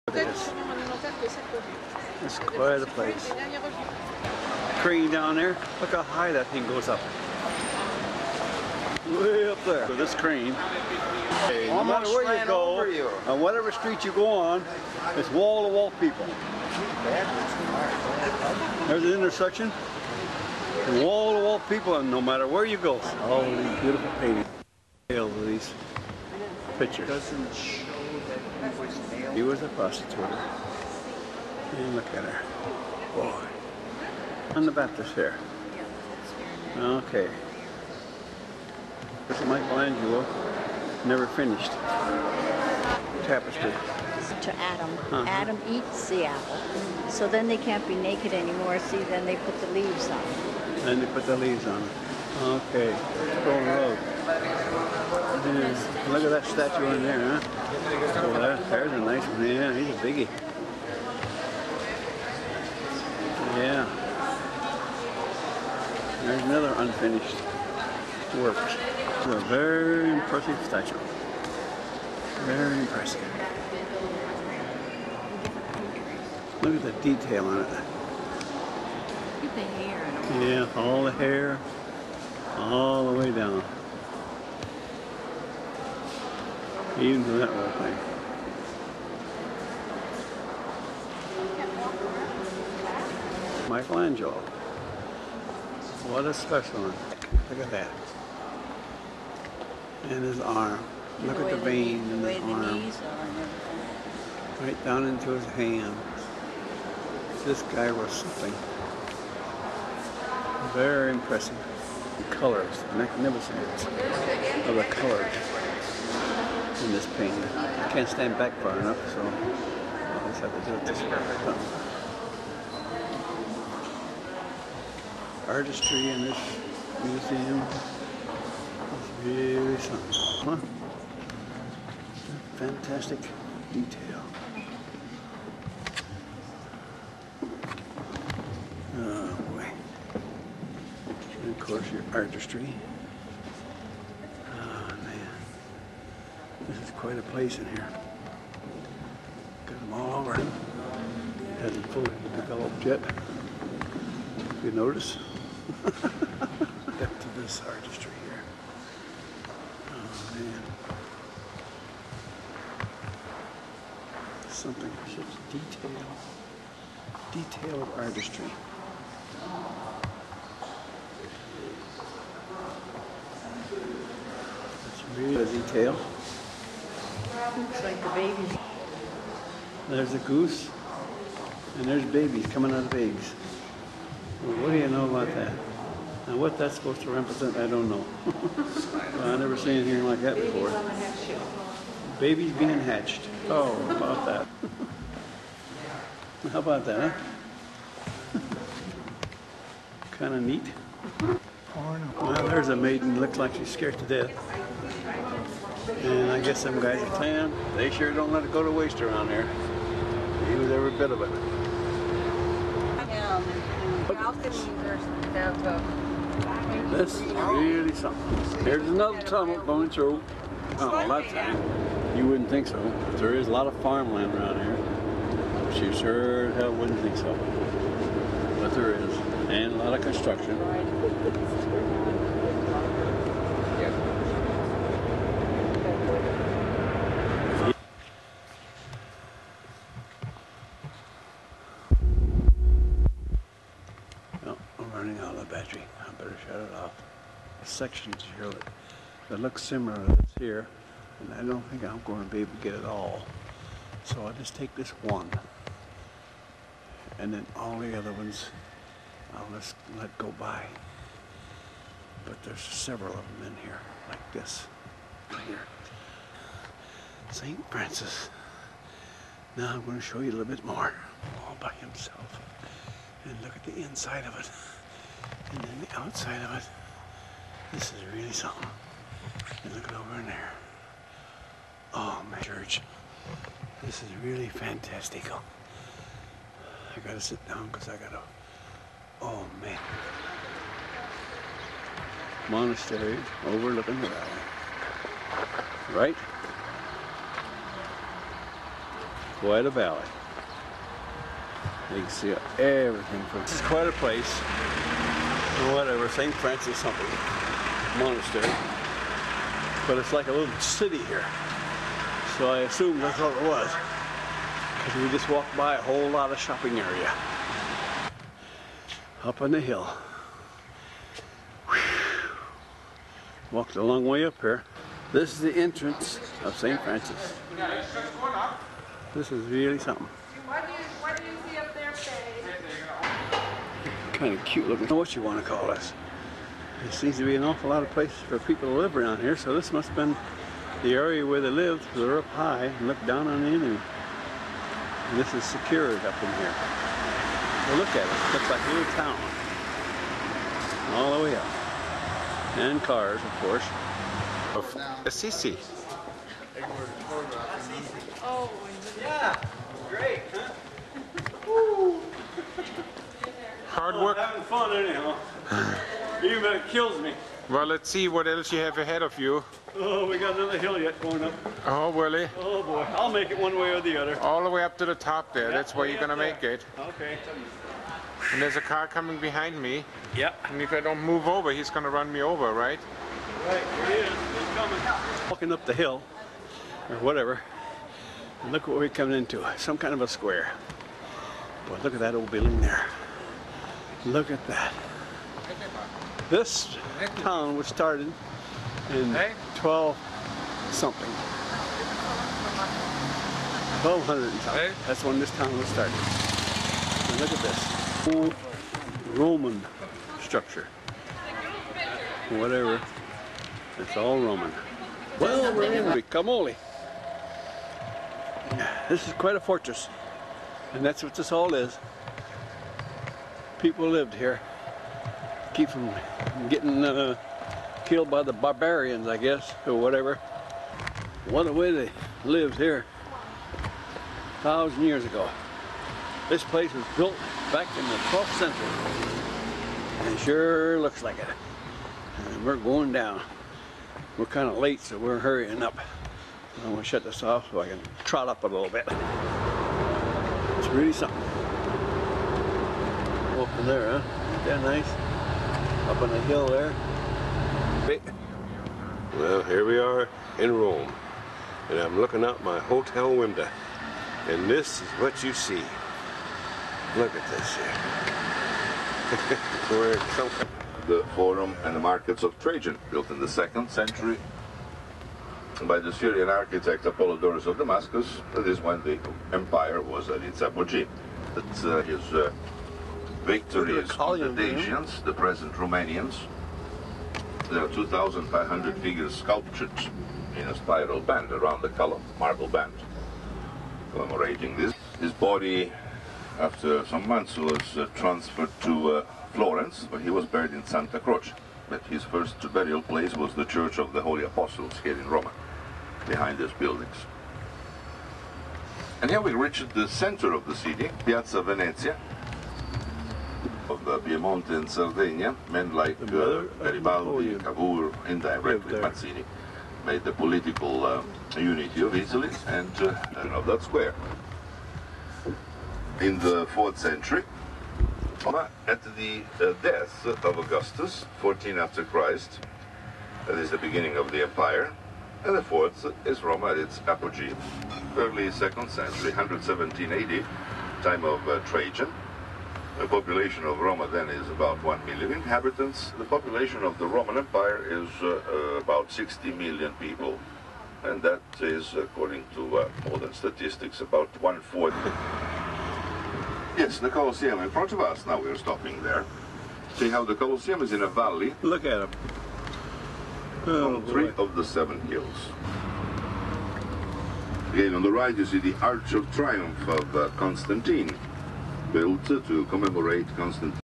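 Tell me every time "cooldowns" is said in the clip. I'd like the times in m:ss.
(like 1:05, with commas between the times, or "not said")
not said.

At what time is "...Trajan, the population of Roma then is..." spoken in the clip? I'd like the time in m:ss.
9:01.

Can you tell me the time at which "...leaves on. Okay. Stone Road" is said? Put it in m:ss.
0:51.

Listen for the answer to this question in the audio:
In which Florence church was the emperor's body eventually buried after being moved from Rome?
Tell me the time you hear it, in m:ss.
8:20.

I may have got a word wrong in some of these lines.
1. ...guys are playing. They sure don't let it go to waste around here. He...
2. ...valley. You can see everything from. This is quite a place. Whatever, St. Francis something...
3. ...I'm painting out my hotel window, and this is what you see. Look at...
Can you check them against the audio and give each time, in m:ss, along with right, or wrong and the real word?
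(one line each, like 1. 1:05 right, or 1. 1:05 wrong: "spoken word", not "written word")
1. 3:26 right
2. 4:59 right
3. 7:41 wrong: "looking", not "painting".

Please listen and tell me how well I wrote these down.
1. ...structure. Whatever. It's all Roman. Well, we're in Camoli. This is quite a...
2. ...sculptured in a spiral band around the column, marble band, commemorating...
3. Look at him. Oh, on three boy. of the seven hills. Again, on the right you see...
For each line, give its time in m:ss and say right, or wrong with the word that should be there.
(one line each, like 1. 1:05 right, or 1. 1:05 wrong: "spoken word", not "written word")
1. 6:50 right
2. 8:09 right
3. 9:21 right.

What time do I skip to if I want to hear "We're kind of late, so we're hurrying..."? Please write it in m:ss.
7:24.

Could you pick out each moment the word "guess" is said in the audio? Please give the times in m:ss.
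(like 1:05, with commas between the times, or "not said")
3:26, 7:09.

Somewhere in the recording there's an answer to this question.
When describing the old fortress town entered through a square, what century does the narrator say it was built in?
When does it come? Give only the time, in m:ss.
7:17.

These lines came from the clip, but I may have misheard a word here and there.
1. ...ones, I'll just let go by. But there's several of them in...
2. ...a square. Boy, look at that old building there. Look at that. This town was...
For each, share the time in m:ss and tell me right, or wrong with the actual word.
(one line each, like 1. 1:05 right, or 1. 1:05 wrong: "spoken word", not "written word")
1. 4:18 right
2. 6:30 right.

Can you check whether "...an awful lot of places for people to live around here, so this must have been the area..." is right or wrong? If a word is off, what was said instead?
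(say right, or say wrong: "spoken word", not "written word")
right.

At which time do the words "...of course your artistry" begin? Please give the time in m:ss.
2:21.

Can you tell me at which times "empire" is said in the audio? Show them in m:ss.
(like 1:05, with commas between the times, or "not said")
7:59, 8:54, 9:07.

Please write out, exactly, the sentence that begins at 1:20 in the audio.
yeah, all the hair, all the way down.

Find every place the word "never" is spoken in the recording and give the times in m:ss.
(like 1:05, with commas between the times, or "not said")
0:41, 3:09.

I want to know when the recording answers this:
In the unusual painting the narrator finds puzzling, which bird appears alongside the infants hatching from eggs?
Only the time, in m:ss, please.
2:59.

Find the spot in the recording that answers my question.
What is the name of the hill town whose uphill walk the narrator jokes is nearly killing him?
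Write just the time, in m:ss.
5:54.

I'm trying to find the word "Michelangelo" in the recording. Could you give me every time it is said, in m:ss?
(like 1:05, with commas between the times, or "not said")
0:39, 1:33.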